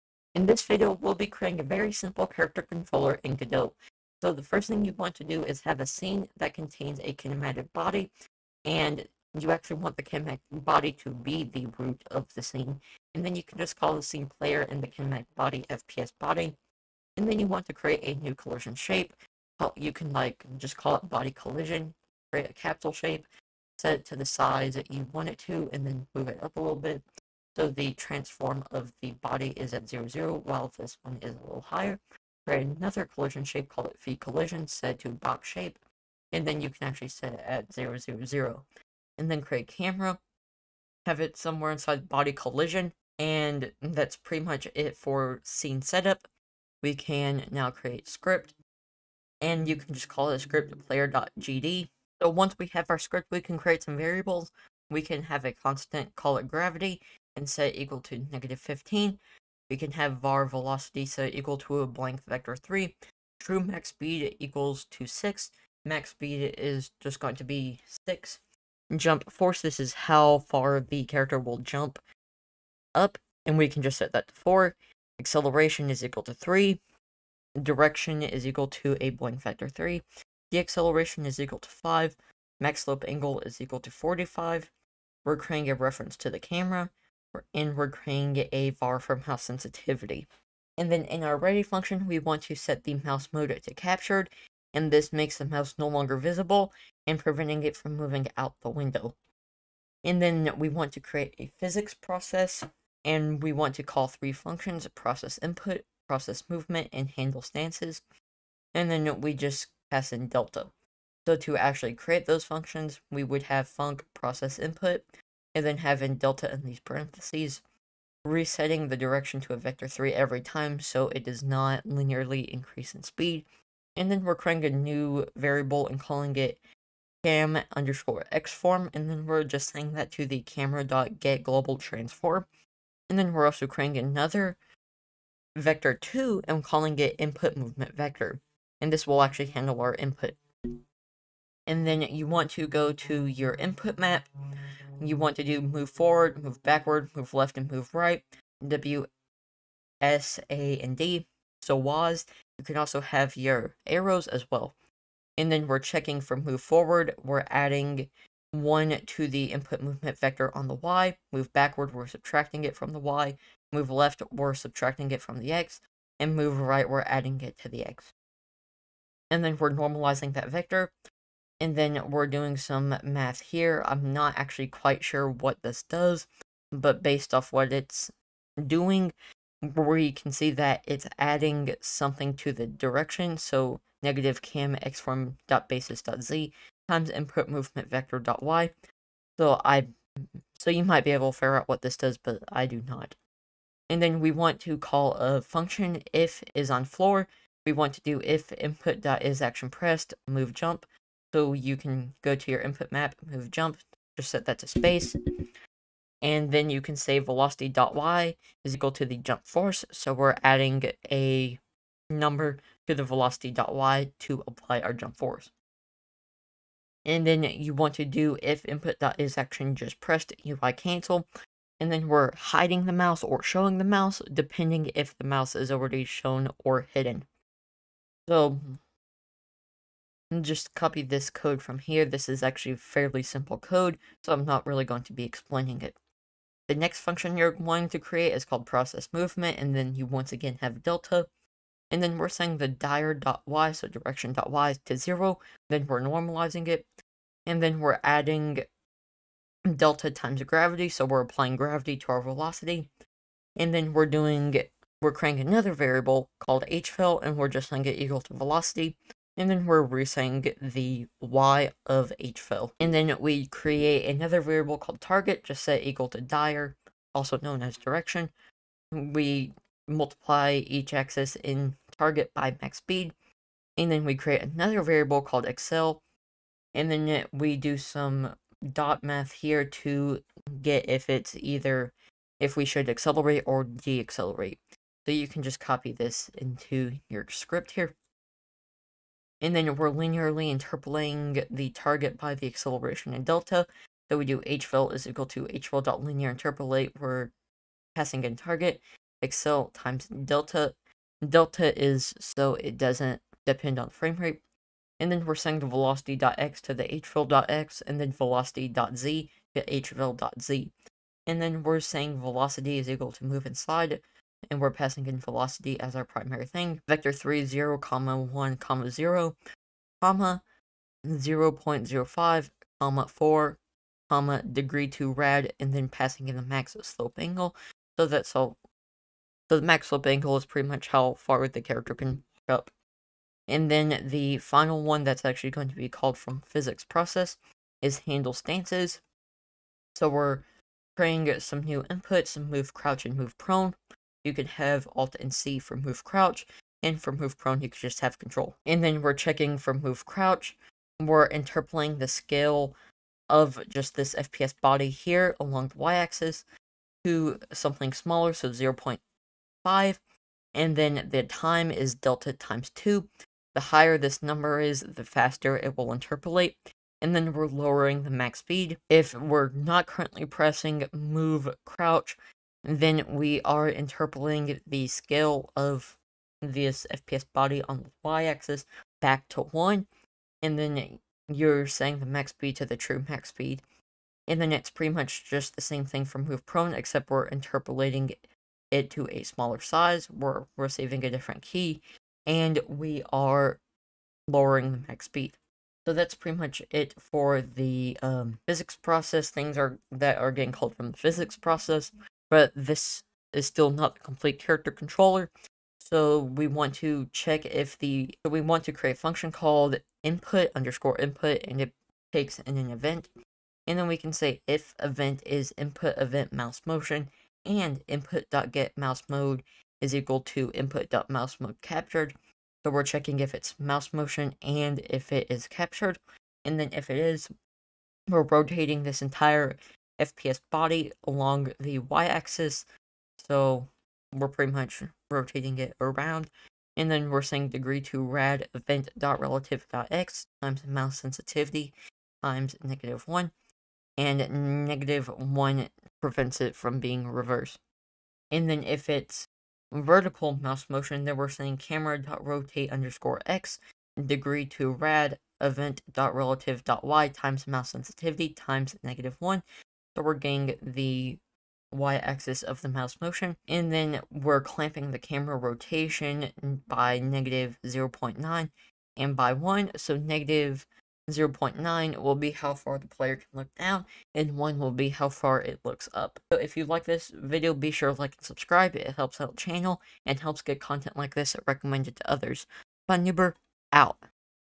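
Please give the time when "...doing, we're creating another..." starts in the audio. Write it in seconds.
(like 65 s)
254 s.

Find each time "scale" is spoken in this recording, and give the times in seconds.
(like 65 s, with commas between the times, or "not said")
352 s, 374 s.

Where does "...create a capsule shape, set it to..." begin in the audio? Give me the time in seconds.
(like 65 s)
22 s.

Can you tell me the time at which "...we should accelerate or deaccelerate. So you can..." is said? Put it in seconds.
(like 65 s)
282 s.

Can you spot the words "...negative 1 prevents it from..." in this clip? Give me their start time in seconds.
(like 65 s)
444 s.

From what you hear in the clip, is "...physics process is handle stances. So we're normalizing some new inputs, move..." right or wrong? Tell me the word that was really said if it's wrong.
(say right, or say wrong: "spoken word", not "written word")
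wrong: "creating", not "normalizing".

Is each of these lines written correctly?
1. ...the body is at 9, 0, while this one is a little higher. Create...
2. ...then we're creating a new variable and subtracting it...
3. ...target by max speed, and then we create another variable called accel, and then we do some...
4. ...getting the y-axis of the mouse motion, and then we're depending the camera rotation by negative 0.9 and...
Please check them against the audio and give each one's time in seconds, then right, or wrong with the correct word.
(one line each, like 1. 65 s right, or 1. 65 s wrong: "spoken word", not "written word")
1. 29 s wrong: "0", not "9"
2. 124 s wrong: "calling", not "subtracting"
3. 271 s right
4. 460 s wrong: "clamping", not "depending".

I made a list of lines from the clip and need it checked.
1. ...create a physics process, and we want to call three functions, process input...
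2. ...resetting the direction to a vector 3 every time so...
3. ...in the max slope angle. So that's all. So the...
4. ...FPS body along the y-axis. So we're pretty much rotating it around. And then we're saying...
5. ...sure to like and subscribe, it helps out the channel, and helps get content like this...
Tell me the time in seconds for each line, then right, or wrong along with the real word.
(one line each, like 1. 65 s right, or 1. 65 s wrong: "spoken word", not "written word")
1. 100 s right
2. 118 s right
3. 326 s right
4. 430 s right
5. 477 s right.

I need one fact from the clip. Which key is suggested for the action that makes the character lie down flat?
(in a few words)
Control.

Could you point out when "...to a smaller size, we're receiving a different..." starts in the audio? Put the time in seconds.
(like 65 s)
388 s.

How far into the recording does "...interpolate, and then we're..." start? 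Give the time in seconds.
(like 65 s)
365 s.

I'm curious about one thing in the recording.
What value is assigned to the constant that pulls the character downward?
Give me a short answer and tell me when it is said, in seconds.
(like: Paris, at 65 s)
-15, at 58 s.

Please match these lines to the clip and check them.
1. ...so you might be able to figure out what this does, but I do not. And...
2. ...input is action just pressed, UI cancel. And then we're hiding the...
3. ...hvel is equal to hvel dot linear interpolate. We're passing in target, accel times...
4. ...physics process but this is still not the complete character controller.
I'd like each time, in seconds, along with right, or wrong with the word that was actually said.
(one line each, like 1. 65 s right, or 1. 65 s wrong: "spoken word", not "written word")
1. 190 s right
2. 218 s right
3. 294 s right
4. 400 s right.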